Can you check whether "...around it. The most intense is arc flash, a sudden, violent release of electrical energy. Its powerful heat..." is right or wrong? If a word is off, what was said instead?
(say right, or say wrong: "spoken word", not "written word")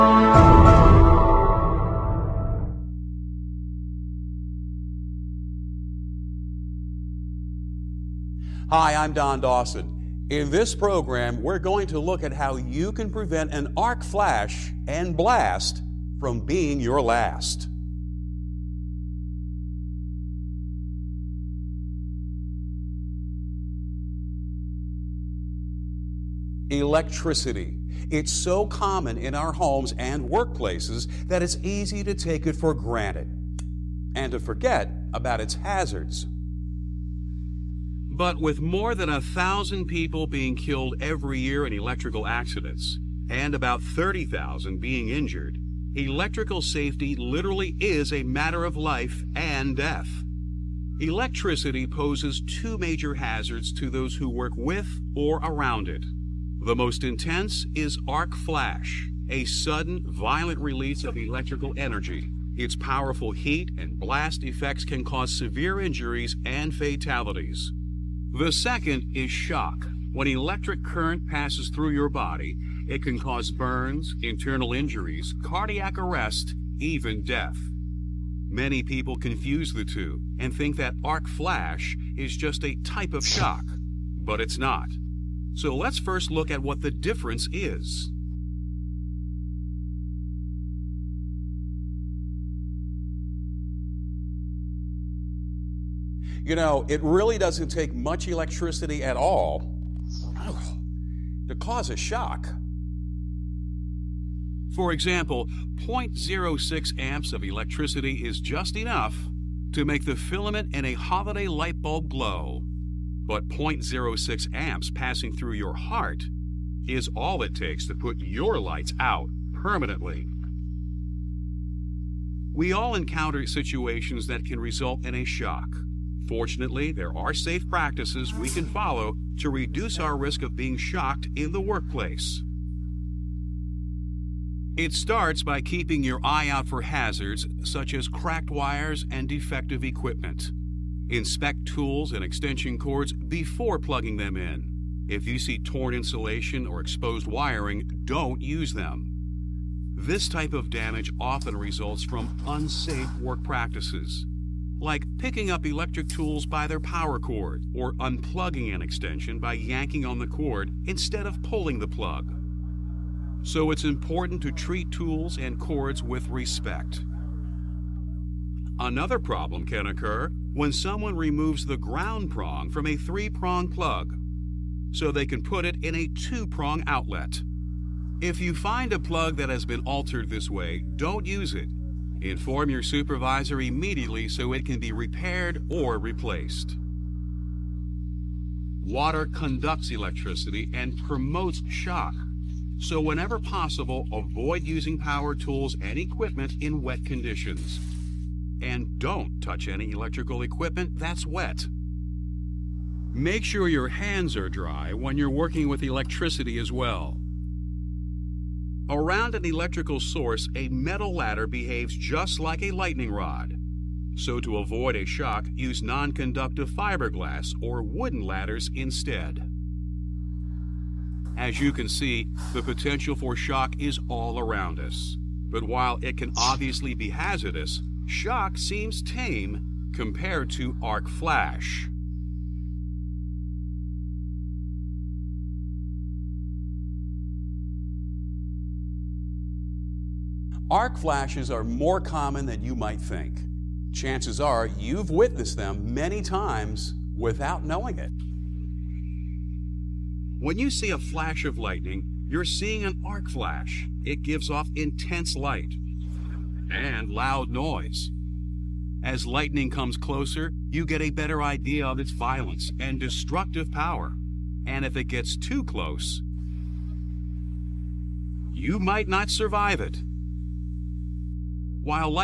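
right.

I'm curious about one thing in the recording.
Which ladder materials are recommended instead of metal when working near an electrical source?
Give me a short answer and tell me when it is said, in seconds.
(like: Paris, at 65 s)
fiberglass or wooden, at 216 s.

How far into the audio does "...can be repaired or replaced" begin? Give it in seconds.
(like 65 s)
184 s.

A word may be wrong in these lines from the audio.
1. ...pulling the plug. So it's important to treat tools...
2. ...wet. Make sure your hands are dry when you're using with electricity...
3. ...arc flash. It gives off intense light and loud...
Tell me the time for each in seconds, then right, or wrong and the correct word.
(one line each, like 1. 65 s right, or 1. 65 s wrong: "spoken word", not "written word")
1. 161 s right
2. 201 s wrong: "working", not "using"
3. 253 s right.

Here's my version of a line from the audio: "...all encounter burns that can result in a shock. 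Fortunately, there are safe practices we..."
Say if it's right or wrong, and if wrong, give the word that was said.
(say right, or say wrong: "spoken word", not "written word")
wrong: "situations", not "burns".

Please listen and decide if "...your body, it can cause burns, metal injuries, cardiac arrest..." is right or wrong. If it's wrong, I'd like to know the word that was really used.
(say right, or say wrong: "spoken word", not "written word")
wrong: "internal", not "metal".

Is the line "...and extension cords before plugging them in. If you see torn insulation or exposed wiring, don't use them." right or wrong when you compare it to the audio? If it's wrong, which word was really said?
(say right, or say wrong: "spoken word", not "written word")
right.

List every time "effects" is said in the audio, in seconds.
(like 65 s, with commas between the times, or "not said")
64 s.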